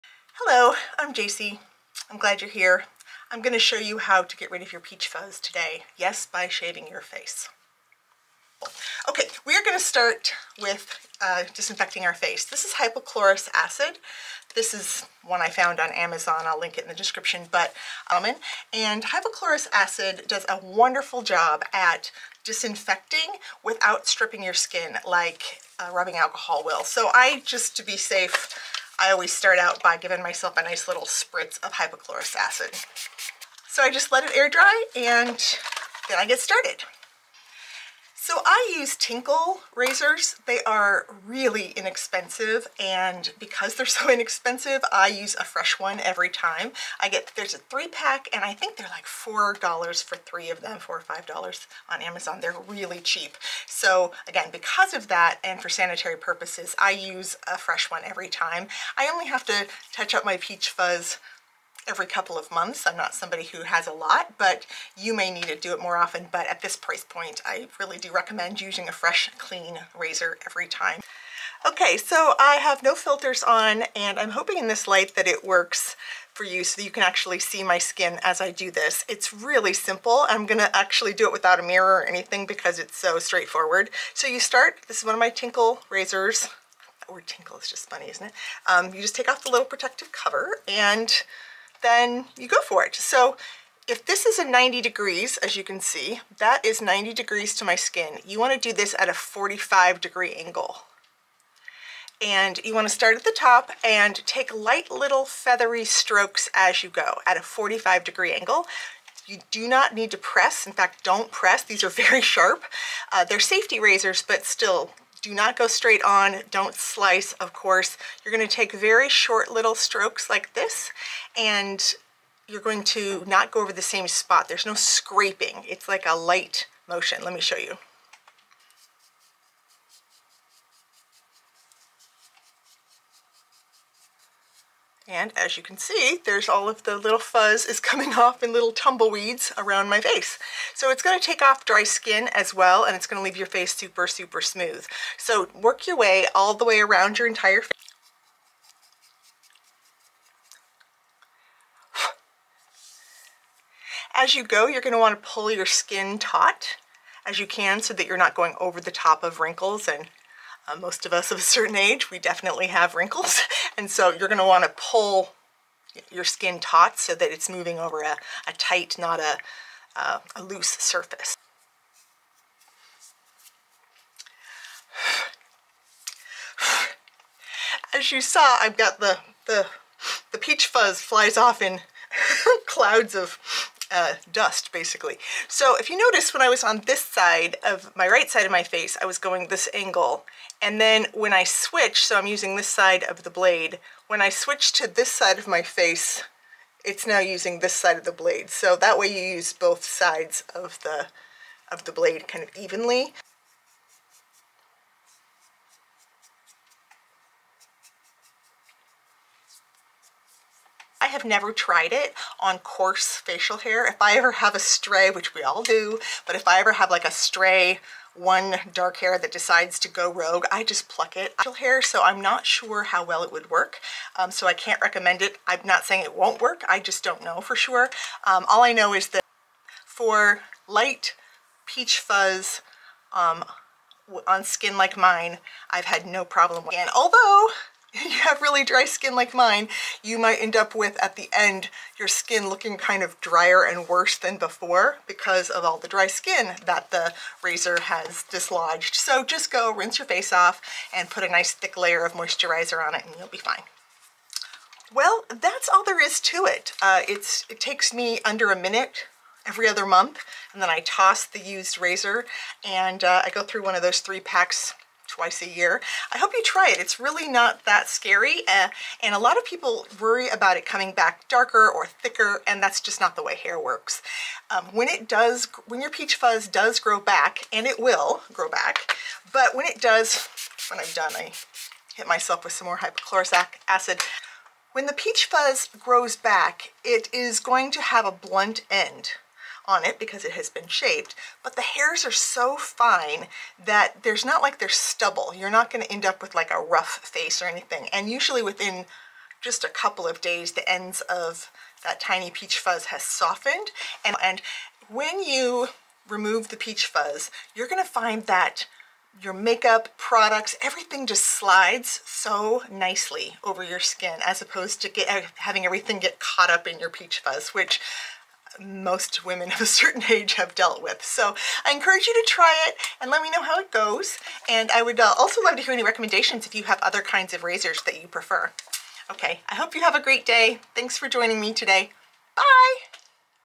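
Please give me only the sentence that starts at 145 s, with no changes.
So work your way all the way around your entire face.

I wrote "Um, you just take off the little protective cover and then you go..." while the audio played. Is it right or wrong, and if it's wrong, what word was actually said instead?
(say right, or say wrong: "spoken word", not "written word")
right.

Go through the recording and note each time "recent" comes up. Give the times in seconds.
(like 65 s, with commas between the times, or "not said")
not said.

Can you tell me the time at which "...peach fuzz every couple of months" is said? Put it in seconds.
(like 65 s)
60 s.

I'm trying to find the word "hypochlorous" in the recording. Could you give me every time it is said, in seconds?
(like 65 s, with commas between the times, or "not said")
12 s, 19 s, 31 s, 282 s.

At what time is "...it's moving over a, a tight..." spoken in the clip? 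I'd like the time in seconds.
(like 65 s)
167 s.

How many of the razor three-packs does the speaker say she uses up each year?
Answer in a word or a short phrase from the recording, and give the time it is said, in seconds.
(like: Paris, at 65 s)
2, at 265 s.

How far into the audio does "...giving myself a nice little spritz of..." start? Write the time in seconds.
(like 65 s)
29 s.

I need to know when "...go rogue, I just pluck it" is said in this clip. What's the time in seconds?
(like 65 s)
219 s.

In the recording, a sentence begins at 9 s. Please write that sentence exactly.
Okay, we're going to start with uh, disinfecting our face.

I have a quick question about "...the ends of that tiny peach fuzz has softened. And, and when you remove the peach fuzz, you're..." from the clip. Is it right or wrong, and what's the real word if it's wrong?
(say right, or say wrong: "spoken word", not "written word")
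right.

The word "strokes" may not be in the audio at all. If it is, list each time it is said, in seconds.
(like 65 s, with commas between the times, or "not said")
105 s, 119 s.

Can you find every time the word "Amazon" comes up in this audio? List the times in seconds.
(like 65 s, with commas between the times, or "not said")
15 s, 52 s.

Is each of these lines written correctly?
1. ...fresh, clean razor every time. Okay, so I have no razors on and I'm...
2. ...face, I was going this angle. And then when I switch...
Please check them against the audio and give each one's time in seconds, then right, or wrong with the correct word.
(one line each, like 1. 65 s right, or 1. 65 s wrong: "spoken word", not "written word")
1. 68 s wrong: "filters", not "razors"
2. 188 s right.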